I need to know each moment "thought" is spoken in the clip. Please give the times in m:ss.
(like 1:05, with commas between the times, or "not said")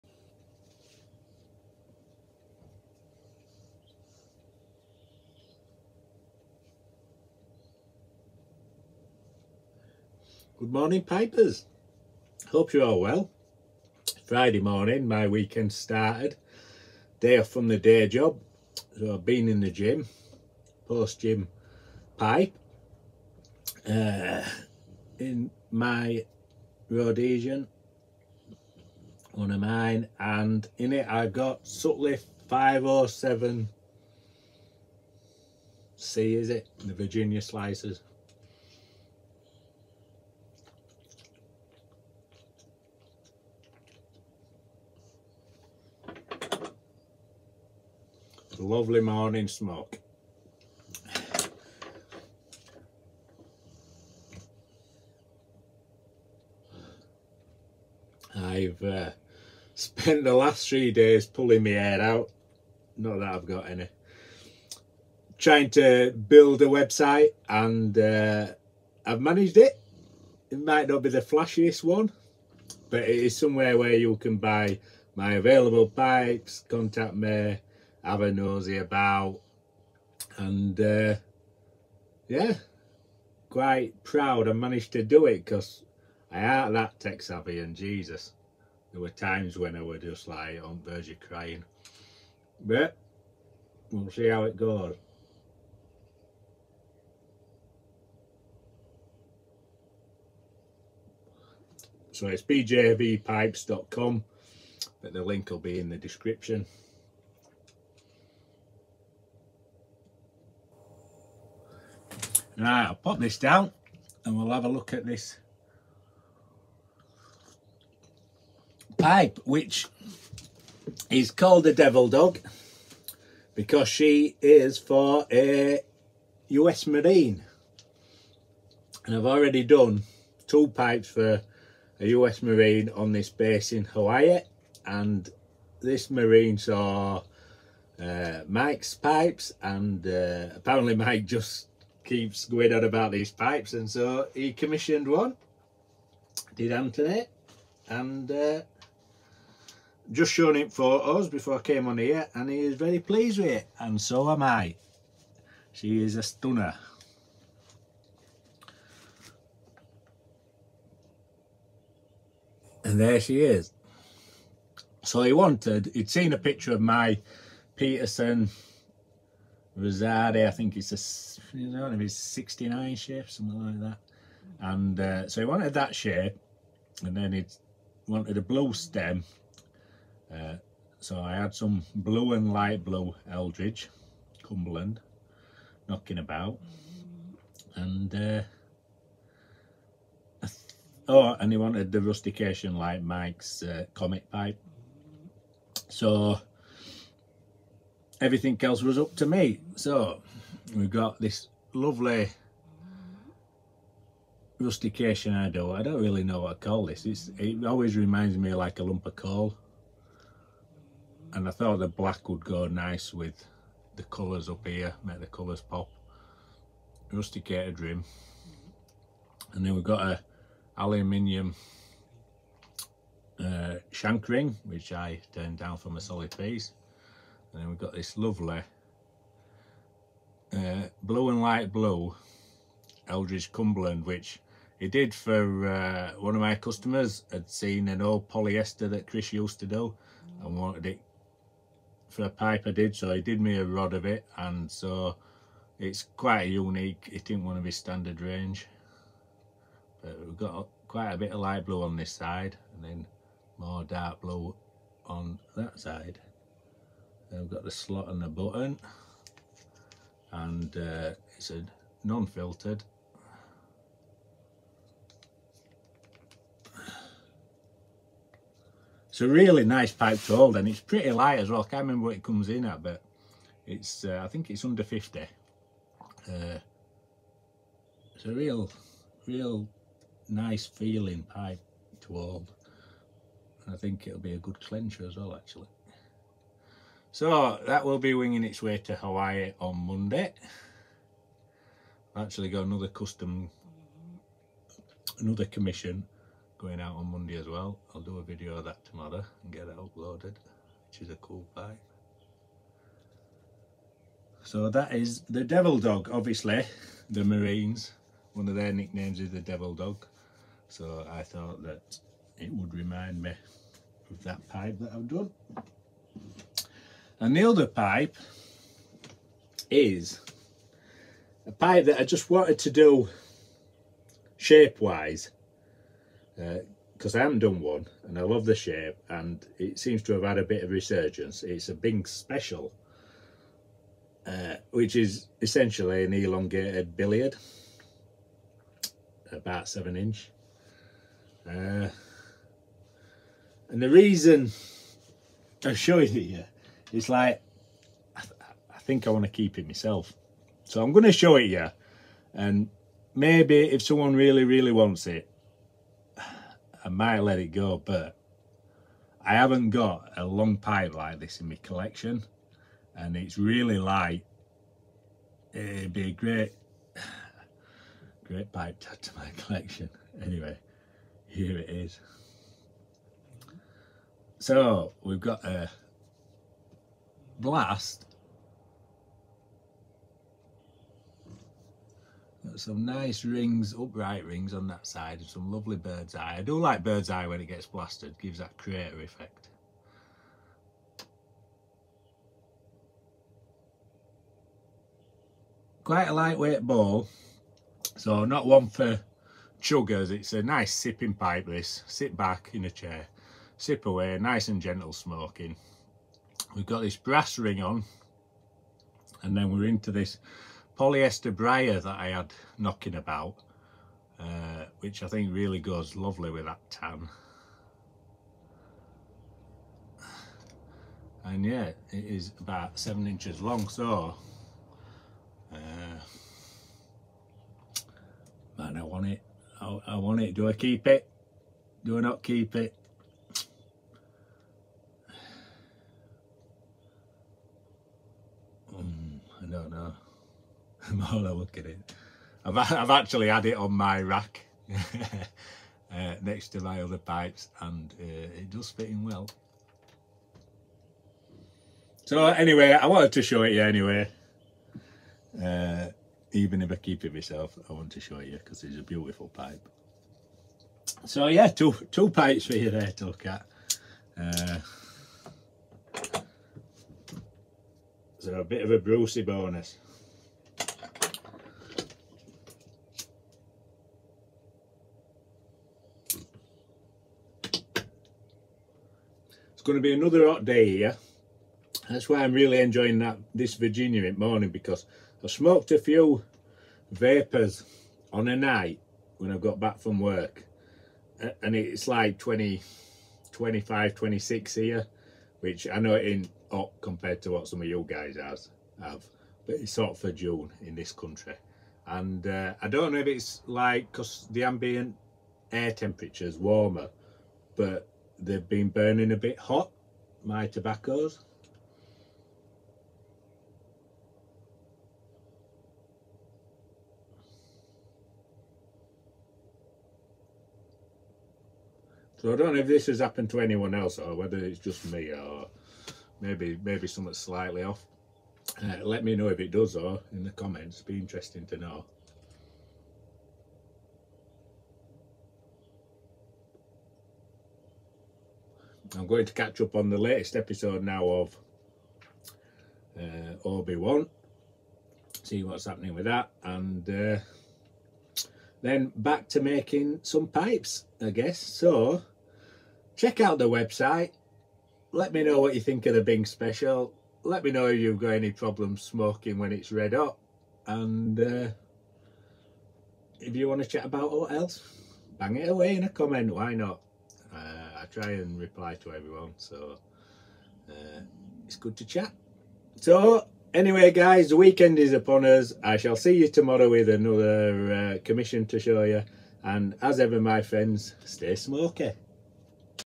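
3:31, 5:11.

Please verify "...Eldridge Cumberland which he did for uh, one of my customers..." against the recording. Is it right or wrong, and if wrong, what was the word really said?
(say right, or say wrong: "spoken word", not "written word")
right.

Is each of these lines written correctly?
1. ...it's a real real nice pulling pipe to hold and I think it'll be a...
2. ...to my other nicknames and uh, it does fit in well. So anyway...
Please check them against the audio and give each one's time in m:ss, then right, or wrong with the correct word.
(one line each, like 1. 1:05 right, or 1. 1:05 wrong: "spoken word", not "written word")
1. 4:38 wrong: "feeling", not "pulling"
2. 7:26 wrong: "pipes", not "nicknames".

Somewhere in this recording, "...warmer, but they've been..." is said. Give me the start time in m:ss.
8:26.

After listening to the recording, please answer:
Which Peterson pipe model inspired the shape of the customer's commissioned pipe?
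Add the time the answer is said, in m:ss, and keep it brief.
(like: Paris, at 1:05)
Rosslare, at 2:49.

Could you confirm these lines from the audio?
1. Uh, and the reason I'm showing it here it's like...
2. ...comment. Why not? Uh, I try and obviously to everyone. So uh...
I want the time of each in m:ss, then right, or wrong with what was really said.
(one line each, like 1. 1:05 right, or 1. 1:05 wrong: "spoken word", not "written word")
1. 5:41 right
2. 9:25 wrong: "reply", not "obviously".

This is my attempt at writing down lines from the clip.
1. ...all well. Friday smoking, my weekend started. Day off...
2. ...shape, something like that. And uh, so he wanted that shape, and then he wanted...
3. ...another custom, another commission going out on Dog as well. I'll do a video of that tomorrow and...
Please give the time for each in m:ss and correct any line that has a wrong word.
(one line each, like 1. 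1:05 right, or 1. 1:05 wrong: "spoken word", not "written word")
1. 0:12 wrong: "morning", not "smoking"
2. 2:52 right
3. 4:52 wrong: "Monday", not "Dog".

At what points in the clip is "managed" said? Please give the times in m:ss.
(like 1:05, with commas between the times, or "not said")
1:09, 1:24.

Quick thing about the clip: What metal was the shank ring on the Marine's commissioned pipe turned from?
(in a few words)
Aluminium.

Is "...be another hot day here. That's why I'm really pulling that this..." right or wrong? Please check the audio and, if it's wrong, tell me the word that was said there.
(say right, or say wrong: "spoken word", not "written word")
wrong: "enjoying", not "pulling".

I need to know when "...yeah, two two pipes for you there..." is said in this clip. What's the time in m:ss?
7:41.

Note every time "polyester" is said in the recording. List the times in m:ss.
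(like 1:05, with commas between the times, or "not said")
3:58, 6:50.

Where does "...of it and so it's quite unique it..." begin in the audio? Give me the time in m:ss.
4:03.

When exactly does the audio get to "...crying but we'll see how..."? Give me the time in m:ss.
1:31.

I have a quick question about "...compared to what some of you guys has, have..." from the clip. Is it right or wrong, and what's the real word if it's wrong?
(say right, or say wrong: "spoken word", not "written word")
right.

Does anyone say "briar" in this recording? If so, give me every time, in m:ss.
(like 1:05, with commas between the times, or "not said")
6:51.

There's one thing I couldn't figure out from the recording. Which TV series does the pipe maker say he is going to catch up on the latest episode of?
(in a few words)
Obi-Wan.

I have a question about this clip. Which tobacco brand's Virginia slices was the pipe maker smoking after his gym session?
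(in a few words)
Sutliff 507 C.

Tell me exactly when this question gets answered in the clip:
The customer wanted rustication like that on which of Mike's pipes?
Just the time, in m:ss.
3:13.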